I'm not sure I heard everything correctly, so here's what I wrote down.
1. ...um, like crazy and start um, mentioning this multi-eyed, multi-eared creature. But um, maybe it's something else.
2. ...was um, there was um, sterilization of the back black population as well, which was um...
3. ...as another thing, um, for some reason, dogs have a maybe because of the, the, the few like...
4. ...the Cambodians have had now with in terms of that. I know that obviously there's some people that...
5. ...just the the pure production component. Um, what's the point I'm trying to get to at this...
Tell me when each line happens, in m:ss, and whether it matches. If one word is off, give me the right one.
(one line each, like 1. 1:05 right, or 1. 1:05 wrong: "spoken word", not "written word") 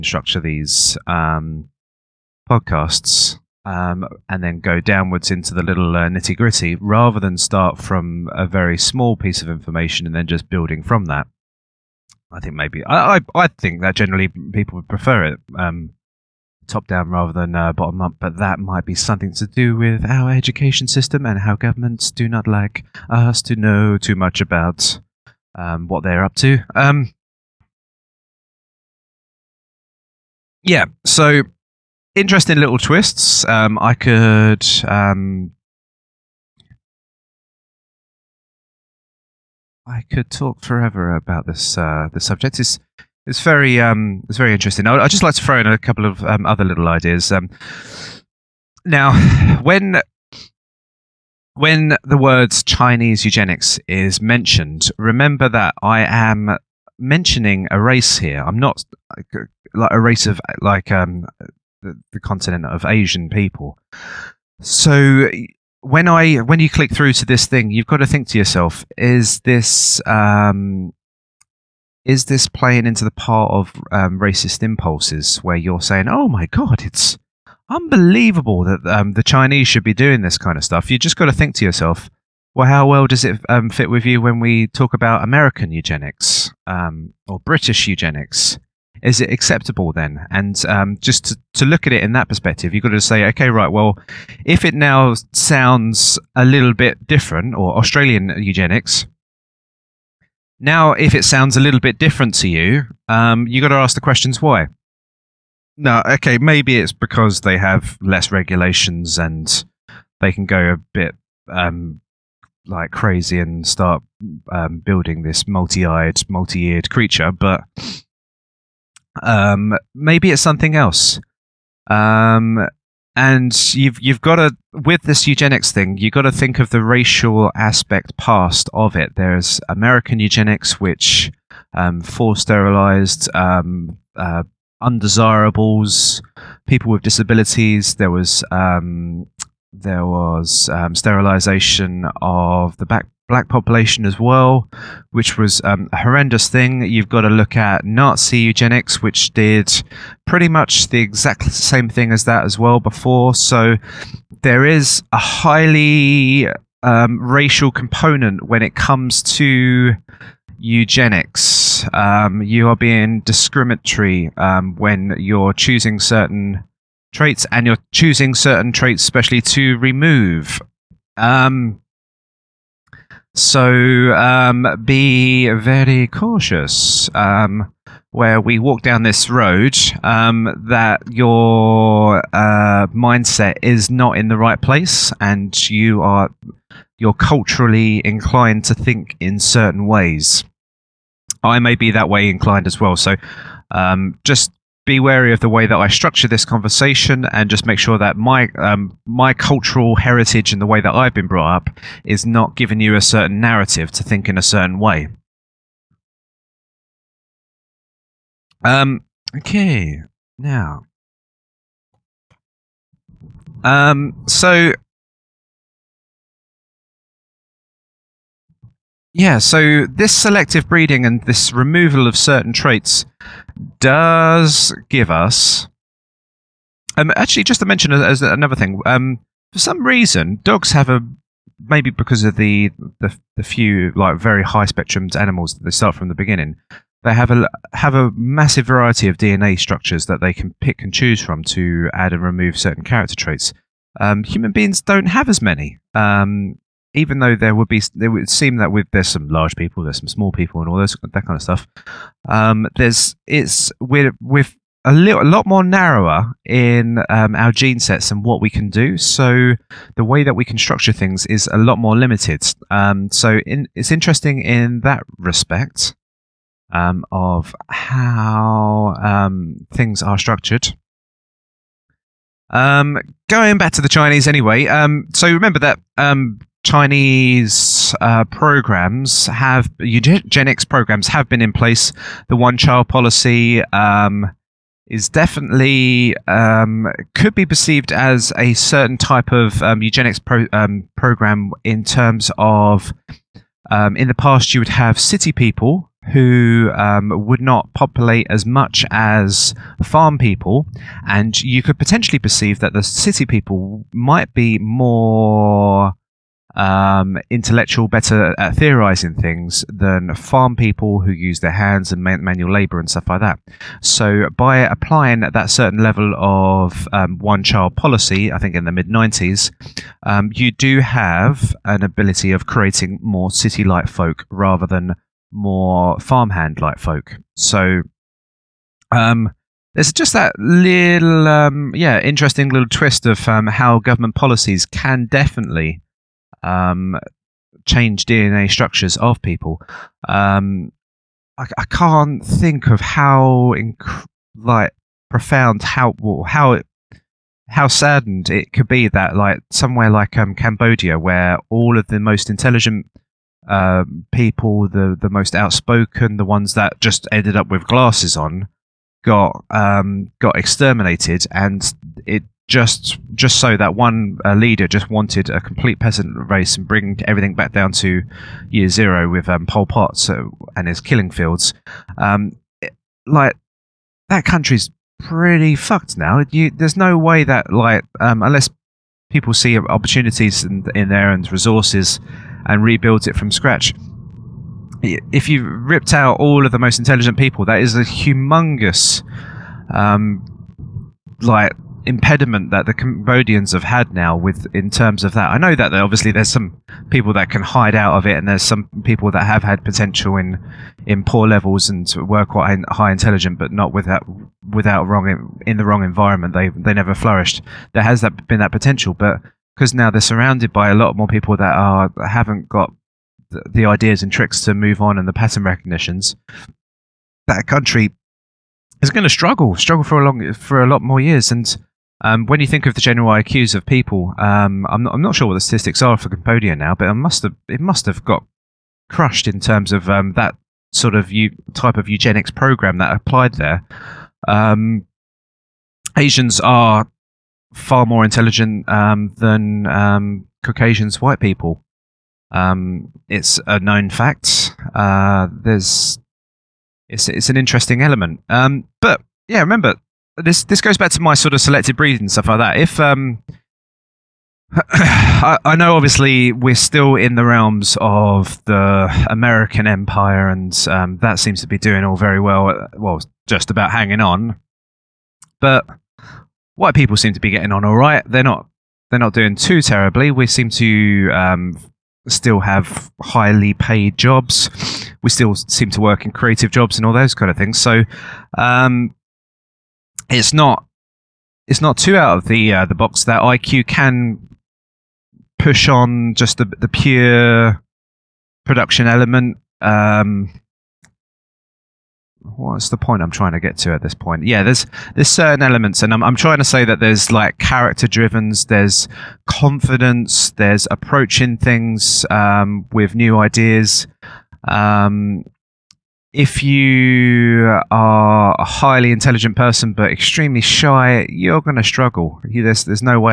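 1. 1:51 wrong: "building", not "mentioning"
2. 2:18 right
3. 3:47 right
4. 6:32 right
5. 8:06 wrong: "element", not "component".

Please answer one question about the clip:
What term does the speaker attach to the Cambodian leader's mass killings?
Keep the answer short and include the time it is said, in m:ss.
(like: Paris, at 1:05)
killing fields, at 6:10.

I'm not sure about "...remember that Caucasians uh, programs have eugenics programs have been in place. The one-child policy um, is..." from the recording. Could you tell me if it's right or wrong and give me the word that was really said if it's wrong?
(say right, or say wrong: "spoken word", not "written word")
wrong: "Chinese", not "Caucasians".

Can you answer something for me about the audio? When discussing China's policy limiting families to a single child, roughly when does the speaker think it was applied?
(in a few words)
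mid 90s.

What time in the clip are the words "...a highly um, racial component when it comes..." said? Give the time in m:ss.
2:35.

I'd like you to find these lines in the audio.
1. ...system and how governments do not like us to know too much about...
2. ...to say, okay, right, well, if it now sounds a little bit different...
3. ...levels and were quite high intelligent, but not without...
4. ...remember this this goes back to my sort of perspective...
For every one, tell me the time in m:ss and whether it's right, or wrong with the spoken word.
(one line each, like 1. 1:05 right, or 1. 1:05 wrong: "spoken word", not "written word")
1. 0:20 right
2. 1:32 right
3. 6:41 right
4. 7:29 wrong: "selective", not "perspective".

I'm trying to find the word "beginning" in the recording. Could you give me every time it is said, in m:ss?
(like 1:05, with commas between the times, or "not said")
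3:56.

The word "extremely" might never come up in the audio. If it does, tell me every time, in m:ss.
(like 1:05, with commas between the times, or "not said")
8:29.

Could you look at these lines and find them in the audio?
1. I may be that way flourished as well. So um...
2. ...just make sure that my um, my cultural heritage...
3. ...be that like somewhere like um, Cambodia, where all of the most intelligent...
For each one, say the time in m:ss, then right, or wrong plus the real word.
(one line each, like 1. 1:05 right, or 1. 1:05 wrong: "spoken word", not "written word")
1. 3:11 wrong: "inclined", not "flourished"
2. 3:17 right
3. 5:48 right.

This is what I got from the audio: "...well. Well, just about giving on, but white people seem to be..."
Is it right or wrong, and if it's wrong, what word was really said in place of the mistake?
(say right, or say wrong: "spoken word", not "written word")
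wrong: "hanging", not "giving".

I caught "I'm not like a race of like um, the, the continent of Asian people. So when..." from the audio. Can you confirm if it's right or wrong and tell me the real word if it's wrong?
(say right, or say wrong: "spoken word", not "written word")
right.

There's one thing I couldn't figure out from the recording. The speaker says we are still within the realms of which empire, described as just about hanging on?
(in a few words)
American Empire.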